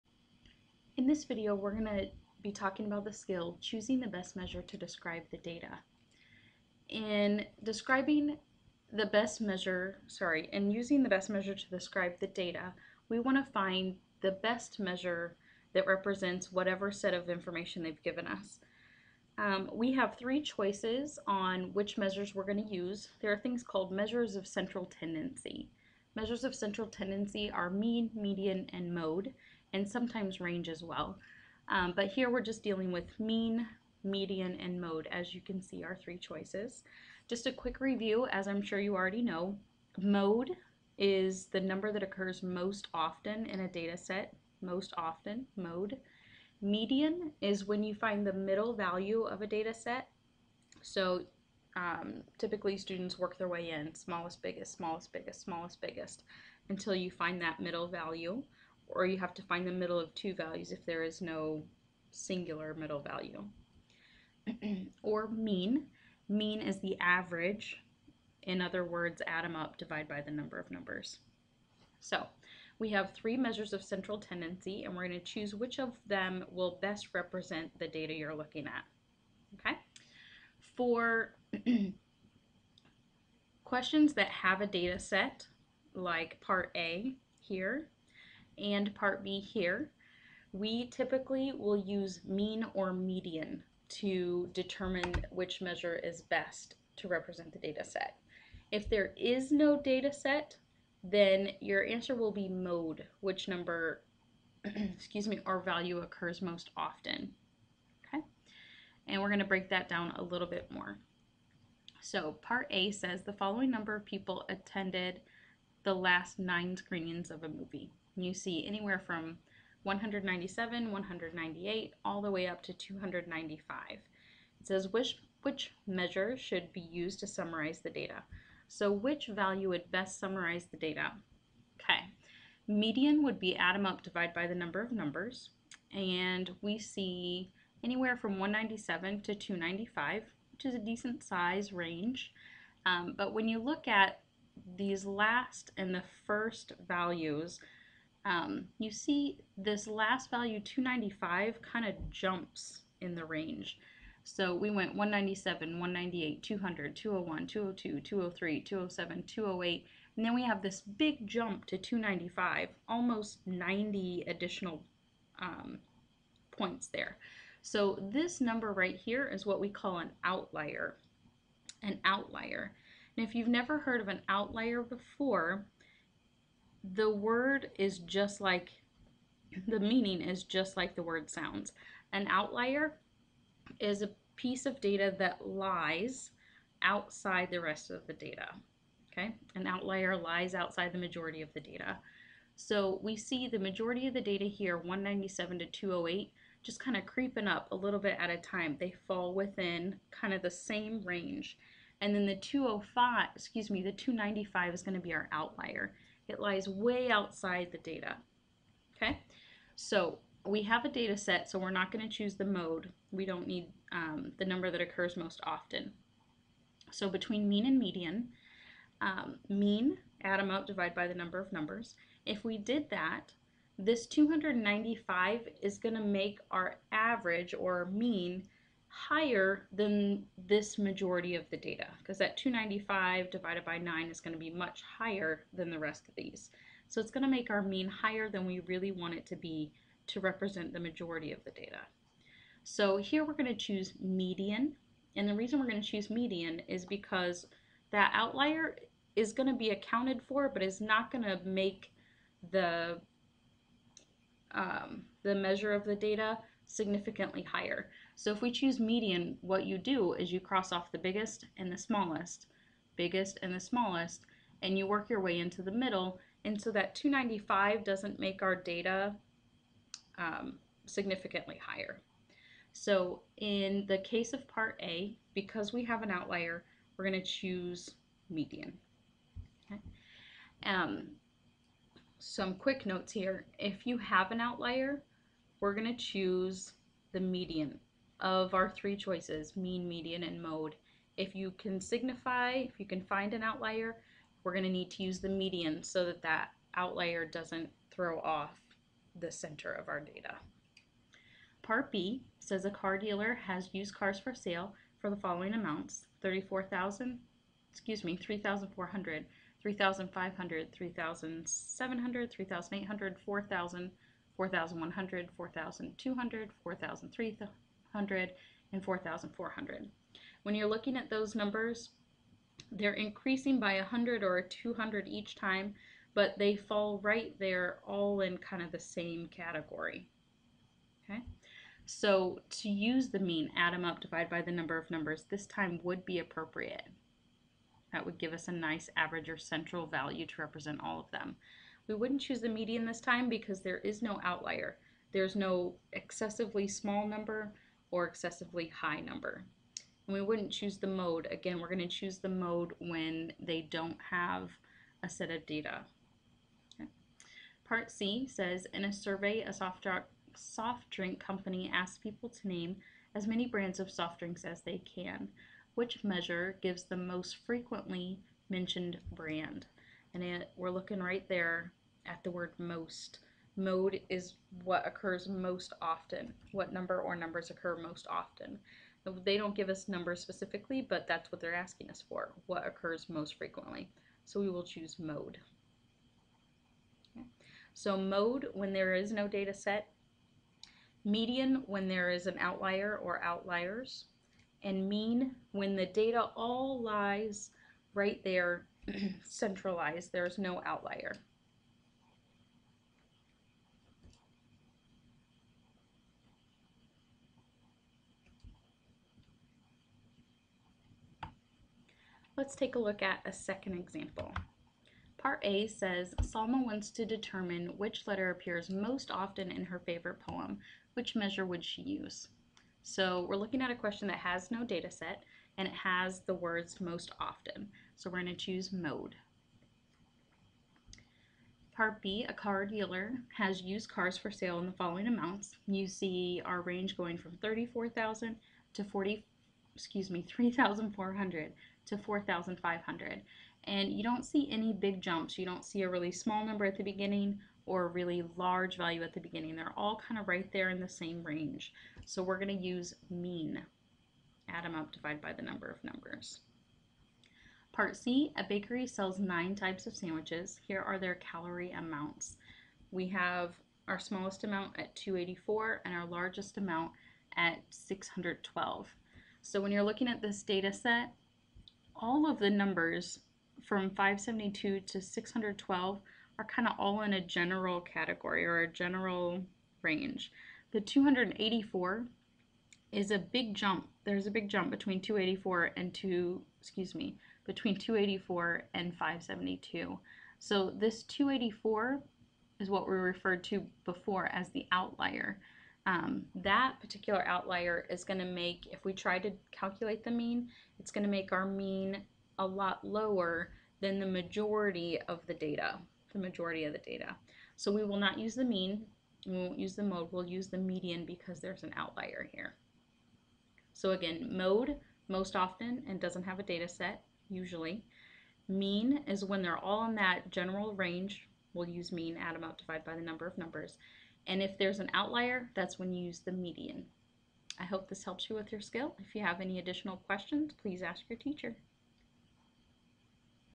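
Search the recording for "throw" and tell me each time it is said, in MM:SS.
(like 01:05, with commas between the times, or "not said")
04:57.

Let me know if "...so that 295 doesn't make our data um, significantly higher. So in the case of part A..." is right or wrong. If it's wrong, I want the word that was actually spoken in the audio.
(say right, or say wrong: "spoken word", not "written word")
right.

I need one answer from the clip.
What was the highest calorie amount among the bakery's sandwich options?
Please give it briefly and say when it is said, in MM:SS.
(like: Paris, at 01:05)
612, at 07:46.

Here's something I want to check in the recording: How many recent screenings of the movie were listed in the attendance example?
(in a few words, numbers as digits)
9.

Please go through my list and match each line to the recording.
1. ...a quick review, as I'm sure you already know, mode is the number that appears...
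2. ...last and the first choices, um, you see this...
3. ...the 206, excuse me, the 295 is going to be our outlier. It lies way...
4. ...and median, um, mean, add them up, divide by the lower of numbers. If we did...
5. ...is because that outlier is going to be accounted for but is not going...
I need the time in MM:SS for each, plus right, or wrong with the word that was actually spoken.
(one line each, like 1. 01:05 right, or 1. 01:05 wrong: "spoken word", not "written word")
1. 00:37 wrong: "occurs", not "appears"
2. 02:25 wrong: "values", not "choices"
3. 03:22 wrong: "205", not "206"
4. 03:37 wrong: "number", not "lower"
5. 04:06 right.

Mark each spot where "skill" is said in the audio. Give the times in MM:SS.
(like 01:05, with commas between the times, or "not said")
00:03, 08:48.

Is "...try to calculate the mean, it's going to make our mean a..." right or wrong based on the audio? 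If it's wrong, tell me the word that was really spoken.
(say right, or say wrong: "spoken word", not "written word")
right.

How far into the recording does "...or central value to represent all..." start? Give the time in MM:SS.
05:39.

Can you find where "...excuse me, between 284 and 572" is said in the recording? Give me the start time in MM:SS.
08:06.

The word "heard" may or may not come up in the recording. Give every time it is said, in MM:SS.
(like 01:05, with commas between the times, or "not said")
02:53.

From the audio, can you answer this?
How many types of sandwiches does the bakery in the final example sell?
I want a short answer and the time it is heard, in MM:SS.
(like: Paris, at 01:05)
9, at 07:39.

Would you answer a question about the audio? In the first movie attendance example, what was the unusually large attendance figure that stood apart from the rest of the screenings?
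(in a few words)
295.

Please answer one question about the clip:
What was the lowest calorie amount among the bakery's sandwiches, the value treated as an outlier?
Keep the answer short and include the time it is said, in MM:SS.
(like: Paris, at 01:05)
284, at 07:43.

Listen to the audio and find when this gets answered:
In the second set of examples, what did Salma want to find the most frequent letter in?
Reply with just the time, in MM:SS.
06:59.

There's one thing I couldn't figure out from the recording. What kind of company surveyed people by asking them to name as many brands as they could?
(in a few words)
Soft drink company.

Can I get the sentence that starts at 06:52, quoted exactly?
Let's take a look at a second example.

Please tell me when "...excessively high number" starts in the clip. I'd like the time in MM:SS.
05:48.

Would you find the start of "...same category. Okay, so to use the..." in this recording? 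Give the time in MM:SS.
05:28.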